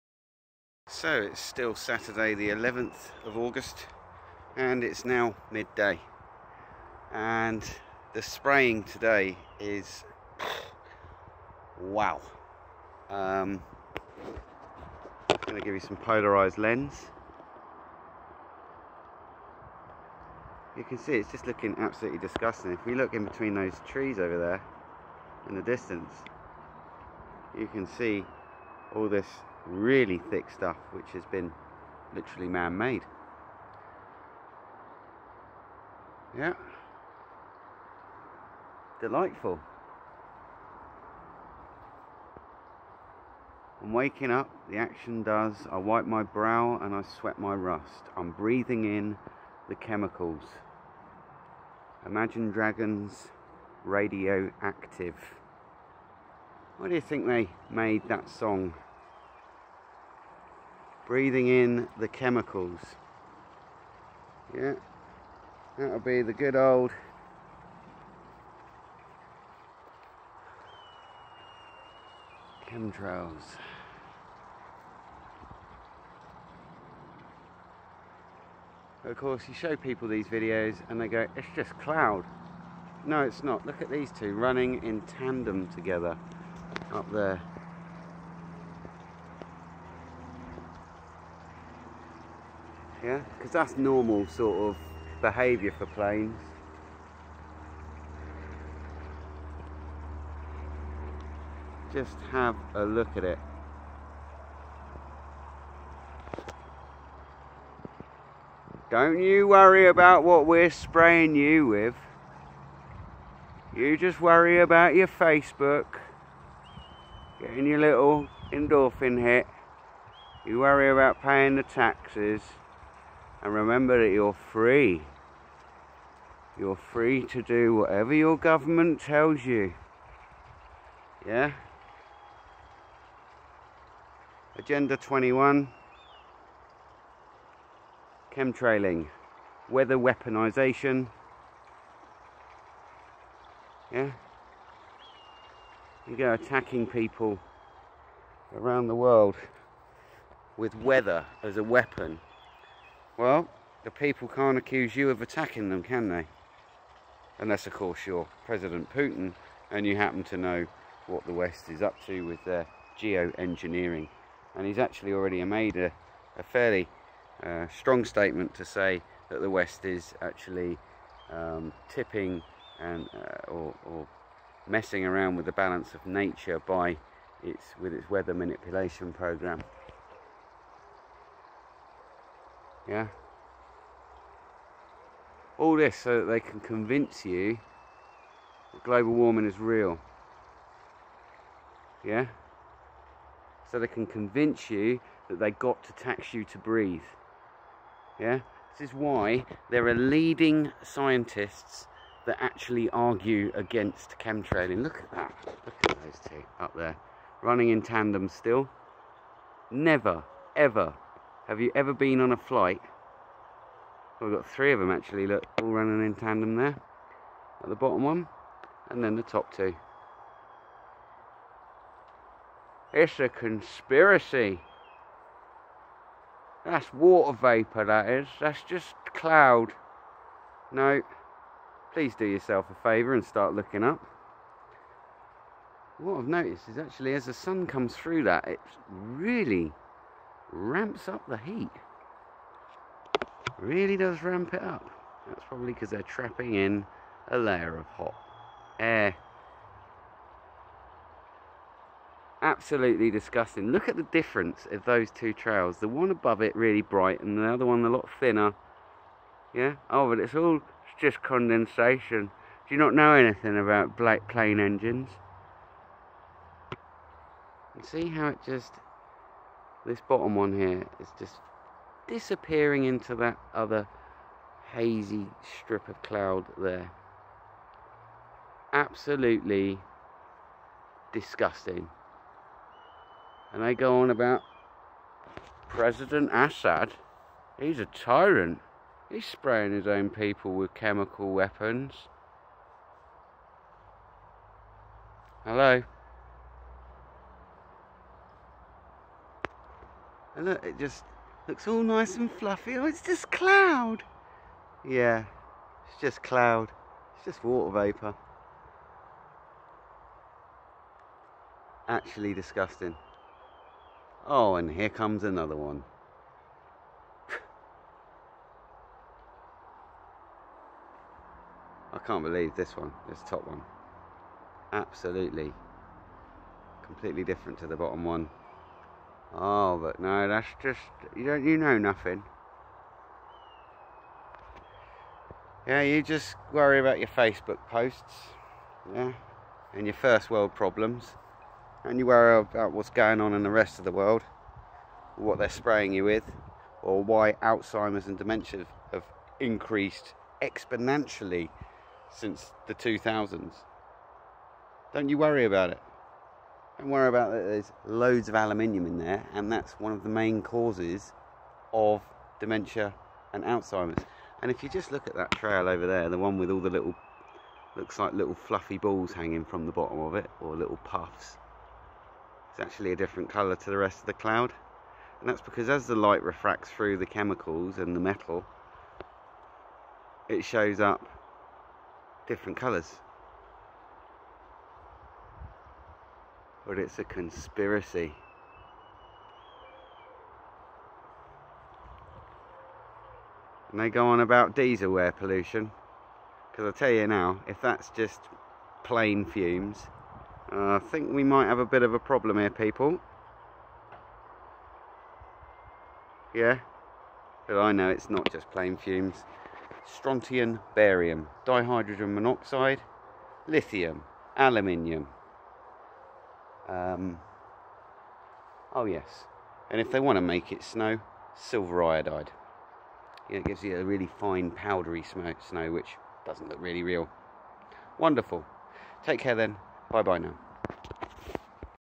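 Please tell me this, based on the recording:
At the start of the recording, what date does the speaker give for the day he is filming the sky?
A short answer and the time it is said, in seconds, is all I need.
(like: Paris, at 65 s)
11th of August, at 2 s.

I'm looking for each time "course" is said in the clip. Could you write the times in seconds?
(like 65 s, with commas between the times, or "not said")
79 s, 157 s.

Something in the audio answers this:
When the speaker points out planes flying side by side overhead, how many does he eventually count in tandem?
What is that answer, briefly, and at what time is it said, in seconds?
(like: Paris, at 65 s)
3, at 214 s.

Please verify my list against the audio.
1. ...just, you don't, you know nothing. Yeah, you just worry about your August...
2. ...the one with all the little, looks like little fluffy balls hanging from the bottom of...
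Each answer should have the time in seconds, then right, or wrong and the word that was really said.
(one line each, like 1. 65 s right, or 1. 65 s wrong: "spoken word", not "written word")
1. 330 s wrong: "Facebook", not "August"
2. 366 s right.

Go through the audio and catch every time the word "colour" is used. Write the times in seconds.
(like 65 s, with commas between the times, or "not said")
373 s, 382 s.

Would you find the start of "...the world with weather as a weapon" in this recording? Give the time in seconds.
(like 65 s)
148 s.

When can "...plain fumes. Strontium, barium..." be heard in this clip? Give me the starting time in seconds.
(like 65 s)
408 s.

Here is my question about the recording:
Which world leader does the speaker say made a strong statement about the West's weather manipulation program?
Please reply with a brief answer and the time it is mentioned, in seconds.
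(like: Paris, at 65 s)
President Putin, at 158 s.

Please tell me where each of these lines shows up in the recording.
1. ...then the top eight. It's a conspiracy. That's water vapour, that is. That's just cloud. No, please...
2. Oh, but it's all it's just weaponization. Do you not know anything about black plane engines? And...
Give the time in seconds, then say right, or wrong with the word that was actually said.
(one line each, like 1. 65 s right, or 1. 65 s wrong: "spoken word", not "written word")
1. 219 s wrong: "two", not "eight"
2. 259 s wrong: "condensation", not "weaponization".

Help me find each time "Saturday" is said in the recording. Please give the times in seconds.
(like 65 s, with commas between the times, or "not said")
1 s.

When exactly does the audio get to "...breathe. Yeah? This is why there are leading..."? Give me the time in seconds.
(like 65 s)
196 s.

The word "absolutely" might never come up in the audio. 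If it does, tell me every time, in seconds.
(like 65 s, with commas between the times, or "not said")
21 s, 252 s, 278 s, 324 s.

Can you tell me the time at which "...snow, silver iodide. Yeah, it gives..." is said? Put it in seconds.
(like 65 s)
420 s.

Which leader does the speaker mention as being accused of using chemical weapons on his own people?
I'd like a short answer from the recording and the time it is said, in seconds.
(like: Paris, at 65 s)
President Assad, at 285 s.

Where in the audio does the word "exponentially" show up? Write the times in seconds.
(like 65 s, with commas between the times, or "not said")
350 s.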